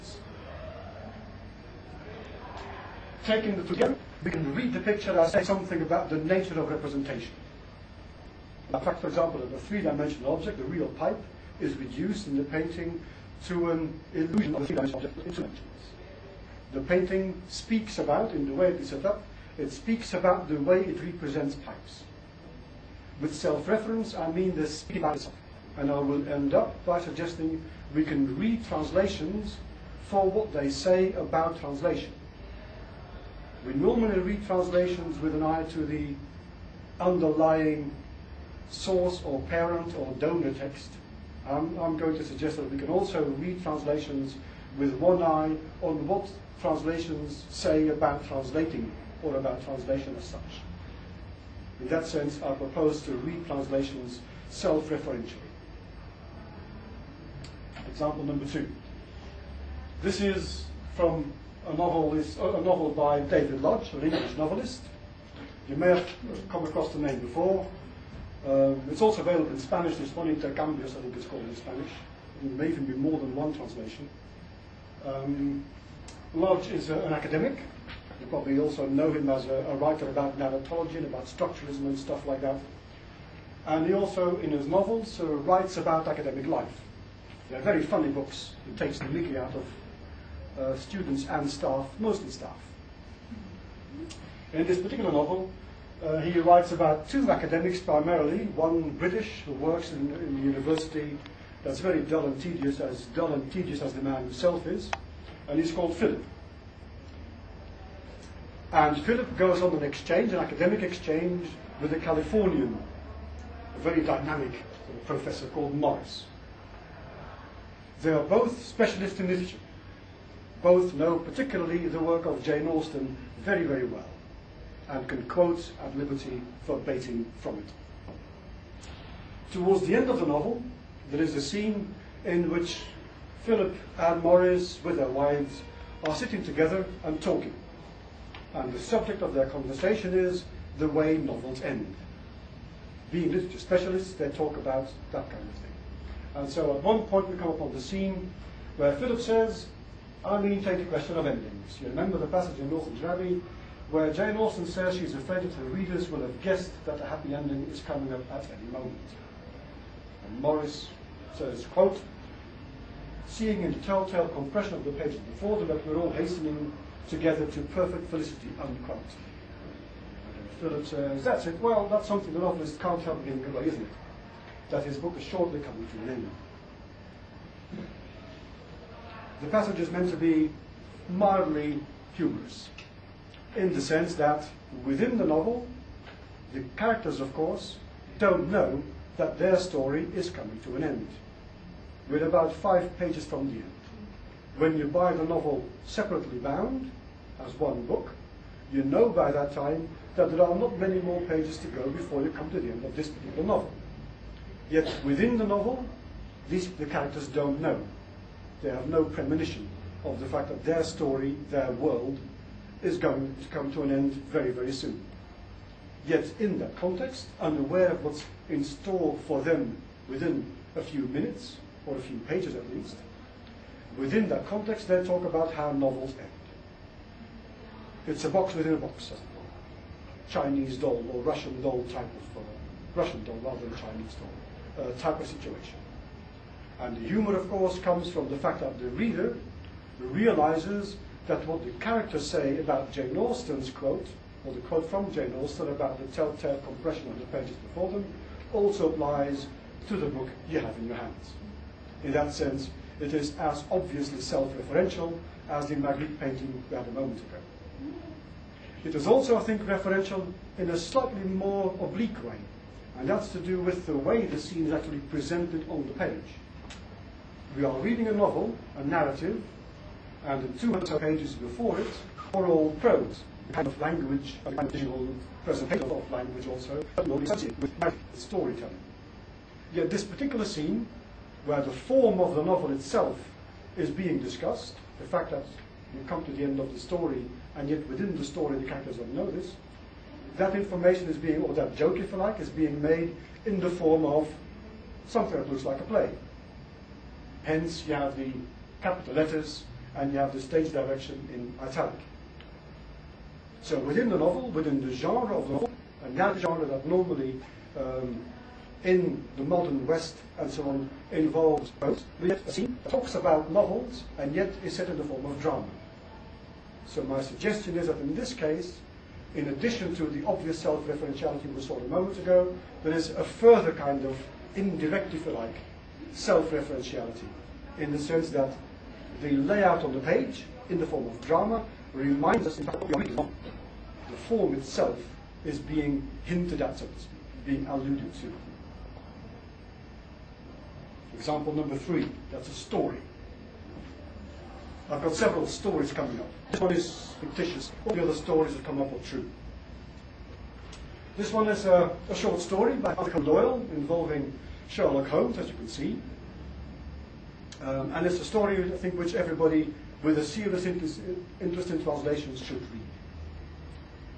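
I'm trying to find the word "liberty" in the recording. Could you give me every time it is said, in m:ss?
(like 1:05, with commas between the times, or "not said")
2:05.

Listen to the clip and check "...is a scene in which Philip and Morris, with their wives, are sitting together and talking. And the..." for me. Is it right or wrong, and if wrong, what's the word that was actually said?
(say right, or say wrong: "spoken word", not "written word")
right.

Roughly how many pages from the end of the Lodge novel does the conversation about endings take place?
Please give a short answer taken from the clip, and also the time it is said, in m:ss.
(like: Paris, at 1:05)
5 pages, at 3:12.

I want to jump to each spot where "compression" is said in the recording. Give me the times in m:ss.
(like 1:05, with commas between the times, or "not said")
2:44, 4:06.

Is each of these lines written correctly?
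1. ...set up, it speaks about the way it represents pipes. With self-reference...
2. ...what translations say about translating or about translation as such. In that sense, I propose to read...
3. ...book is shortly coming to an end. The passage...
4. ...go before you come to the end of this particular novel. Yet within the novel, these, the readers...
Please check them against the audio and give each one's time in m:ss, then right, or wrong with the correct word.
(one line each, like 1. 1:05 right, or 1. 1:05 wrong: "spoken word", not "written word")
1. 0:18 right
2. 0:46 right
3. 2:54 right
4. 3:21 wrong: "characters", not "readers".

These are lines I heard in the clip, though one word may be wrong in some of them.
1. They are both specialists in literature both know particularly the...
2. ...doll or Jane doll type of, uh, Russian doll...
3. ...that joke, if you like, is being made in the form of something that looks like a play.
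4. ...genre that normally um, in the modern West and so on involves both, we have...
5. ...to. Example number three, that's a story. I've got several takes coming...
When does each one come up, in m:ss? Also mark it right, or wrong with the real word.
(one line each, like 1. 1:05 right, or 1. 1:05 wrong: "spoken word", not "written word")
1. 1:58 right
2. 3:50 wrong: "Russian", not "Jane"
3. 4:51 right
4. 5:06 right
5. 5:38 wrong: "stories", not "takes".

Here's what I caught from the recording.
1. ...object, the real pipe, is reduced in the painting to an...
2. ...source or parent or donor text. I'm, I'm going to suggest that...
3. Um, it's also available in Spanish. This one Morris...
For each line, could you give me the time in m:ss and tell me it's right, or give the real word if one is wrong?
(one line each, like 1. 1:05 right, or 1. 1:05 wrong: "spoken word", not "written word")
1. 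0:10 right
2. 0:38 right
3. 1:08 wrong: "Intercambios", not "Morris".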